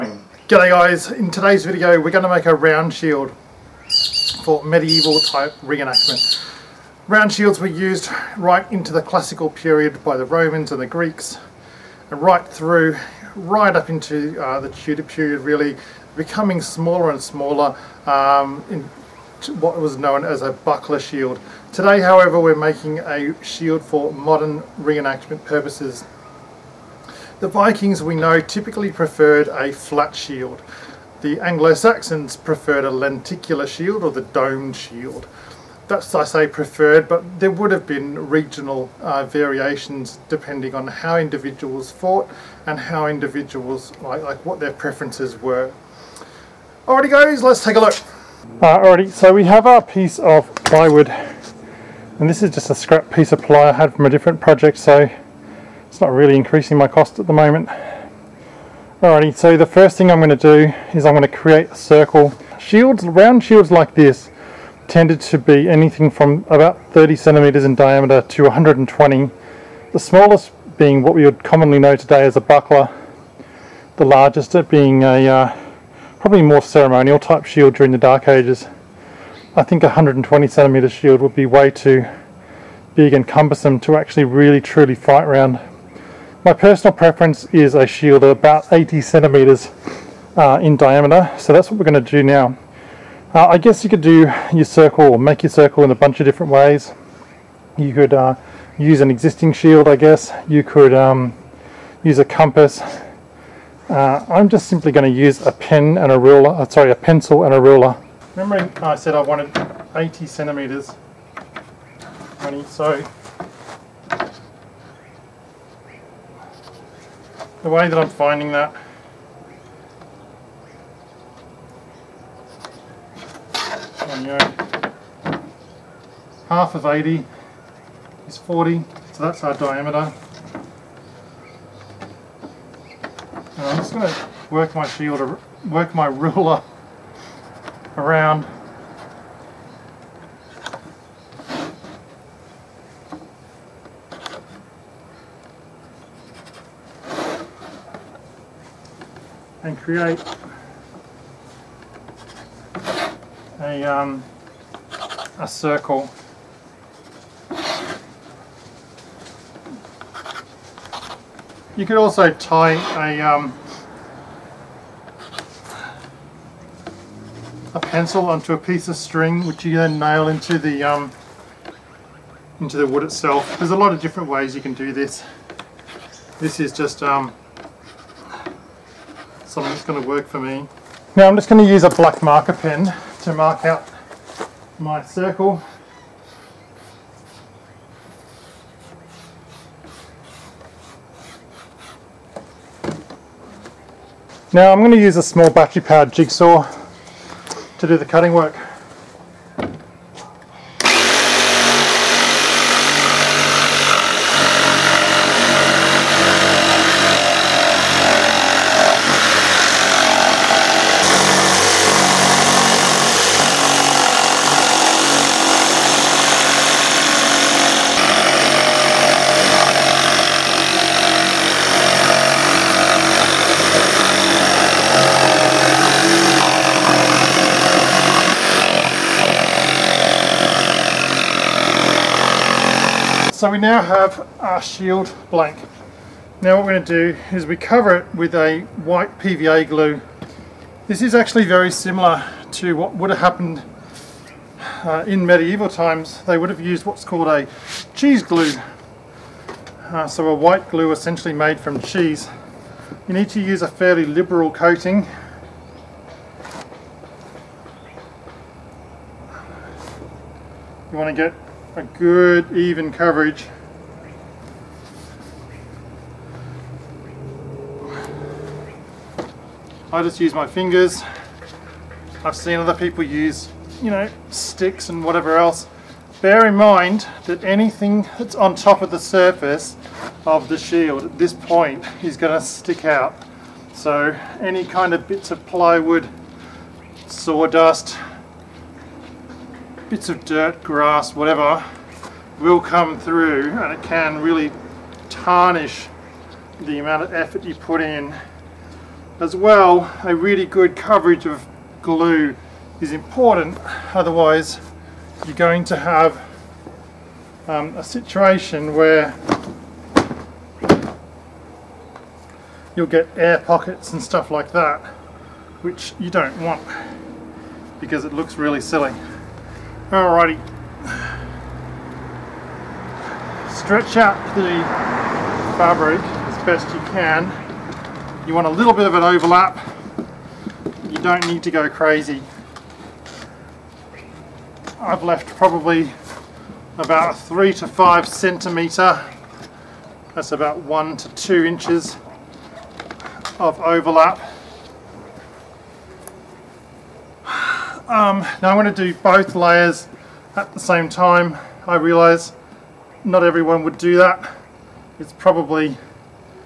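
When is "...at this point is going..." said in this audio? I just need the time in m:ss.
4:41.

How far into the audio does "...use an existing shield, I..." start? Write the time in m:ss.
1:38.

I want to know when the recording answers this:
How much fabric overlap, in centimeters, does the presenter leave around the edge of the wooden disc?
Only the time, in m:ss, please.
5:37.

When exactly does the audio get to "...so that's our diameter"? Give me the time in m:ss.
2:09.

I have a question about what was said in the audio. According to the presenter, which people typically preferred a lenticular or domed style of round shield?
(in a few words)
Anglo-Saxons.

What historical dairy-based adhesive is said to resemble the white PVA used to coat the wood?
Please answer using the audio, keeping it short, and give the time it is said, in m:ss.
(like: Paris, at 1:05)
Cheese glue, at 4:07.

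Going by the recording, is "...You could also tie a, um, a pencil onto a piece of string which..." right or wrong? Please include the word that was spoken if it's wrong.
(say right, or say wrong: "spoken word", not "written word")
right.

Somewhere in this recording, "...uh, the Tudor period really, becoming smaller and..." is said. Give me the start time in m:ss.
0:14.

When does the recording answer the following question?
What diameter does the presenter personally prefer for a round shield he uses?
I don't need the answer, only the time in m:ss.
1:28.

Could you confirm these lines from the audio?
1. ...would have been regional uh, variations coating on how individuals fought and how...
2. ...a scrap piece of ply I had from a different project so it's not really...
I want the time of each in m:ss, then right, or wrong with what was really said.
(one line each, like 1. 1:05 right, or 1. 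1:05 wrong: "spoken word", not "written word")
1. 0:37 wrong: "depending", not "coating"
2. 0:52 right.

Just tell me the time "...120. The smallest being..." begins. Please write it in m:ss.
1:08.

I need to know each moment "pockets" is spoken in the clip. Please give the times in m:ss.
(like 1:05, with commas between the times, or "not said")
5:13.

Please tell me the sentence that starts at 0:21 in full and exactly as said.
Today, however, we're making a shield for modern reenactment purposes.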